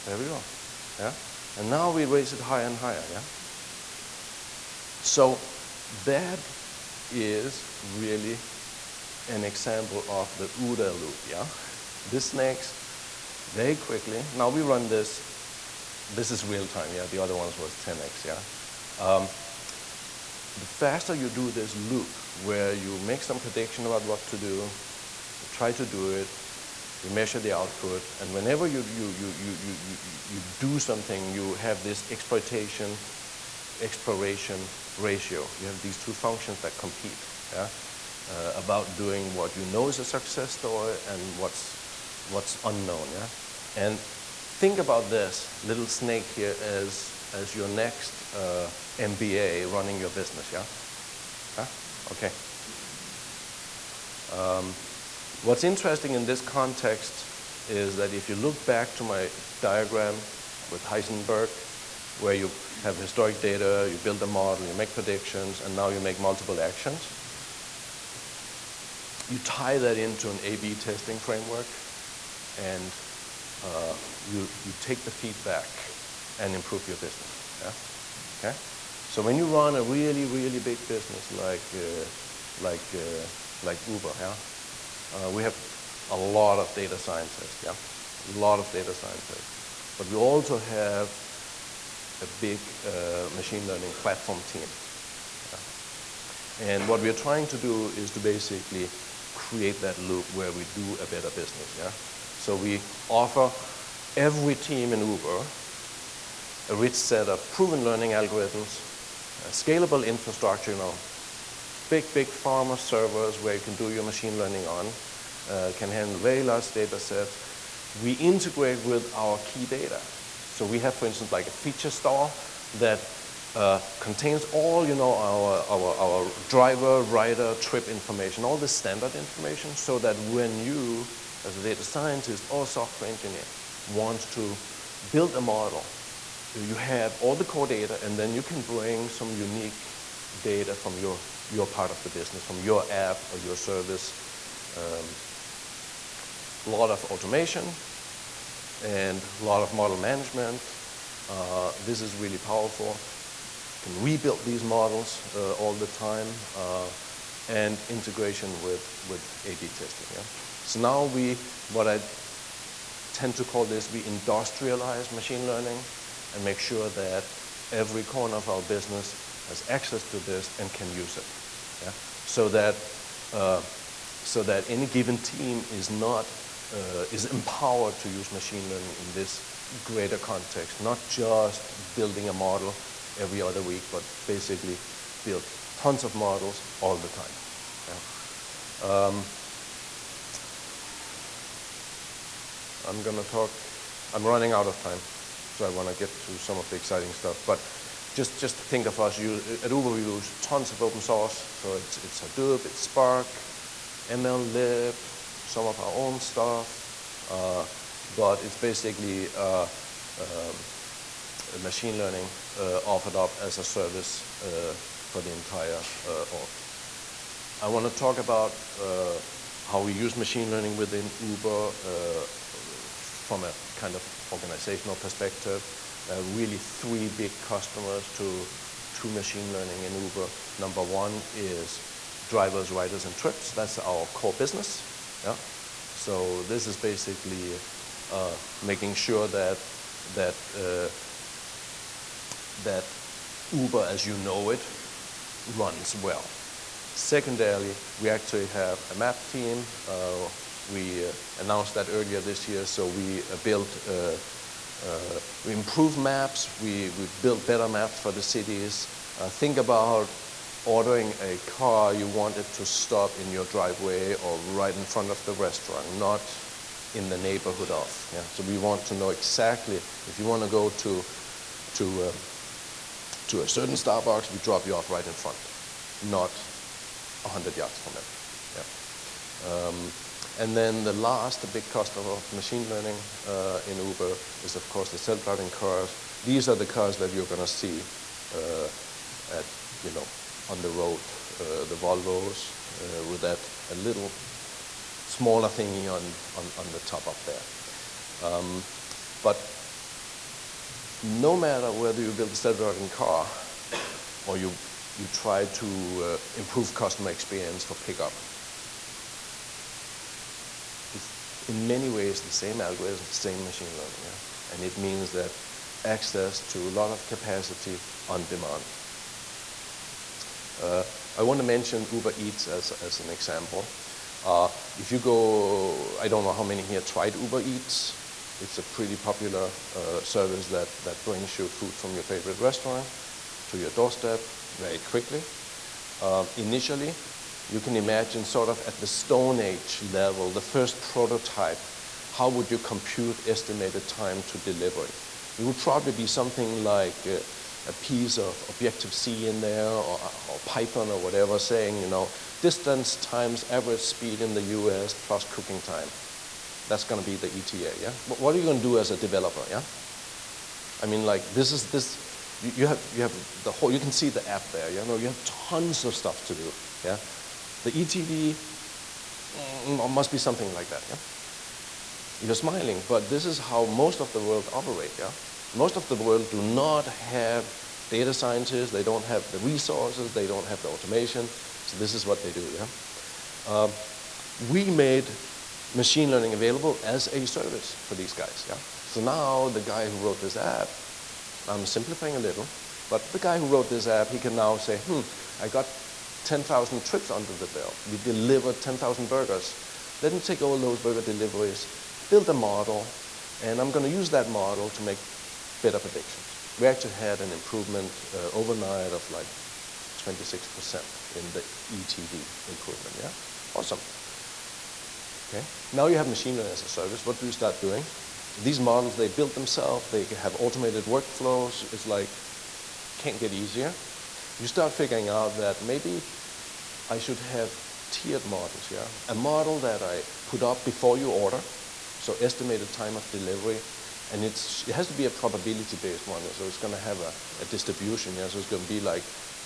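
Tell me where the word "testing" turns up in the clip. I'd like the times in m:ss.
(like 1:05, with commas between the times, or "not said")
1:10, 2:39.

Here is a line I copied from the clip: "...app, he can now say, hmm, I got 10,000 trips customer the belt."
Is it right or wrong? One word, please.
wrong.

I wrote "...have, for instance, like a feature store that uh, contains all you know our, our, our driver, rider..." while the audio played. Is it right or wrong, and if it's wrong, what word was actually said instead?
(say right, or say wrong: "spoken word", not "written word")
right.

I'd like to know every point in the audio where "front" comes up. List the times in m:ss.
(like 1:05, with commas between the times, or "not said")
4:24, 4:35.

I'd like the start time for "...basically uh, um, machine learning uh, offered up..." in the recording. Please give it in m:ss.
3:28.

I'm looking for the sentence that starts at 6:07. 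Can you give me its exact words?
The ETD mm, mm, must be something like that, yeah?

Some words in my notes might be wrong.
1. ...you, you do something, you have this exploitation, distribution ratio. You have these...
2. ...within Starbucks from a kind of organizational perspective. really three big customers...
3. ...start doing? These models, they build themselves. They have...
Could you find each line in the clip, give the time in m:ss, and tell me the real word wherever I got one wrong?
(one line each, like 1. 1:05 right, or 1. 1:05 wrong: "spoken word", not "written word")
1. 0:29 wrong: "exploration", not "distribution"
2. 3:40 wrong: "Uber", not "Starbucks"
3. 6:57 right.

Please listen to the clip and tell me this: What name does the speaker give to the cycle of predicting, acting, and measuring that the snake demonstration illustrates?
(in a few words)
OODA loop.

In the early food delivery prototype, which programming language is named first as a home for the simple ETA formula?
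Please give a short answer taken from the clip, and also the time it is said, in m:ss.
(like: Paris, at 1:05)
Objective-C, at 5:48.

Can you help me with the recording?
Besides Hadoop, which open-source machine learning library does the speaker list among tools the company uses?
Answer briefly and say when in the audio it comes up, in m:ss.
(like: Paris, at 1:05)
MLlib, at 3:24.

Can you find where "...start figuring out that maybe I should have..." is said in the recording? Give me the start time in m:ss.
7:04.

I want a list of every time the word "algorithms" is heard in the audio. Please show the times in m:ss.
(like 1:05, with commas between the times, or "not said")
1:48, 5:12.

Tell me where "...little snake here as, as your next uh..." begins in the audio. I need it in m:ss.
0:45.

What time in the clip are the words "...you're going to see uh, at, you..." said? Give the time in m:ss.
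4:47.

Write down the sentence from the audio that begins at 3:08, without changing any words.
Um, I'm going to talk, I'm running out of time, so I want to get to some of the exciting stuff.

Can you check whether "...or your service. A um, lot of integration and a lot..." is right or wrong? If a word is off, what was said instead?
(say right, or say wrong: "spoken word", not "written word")
wrong: "automation", not "integration".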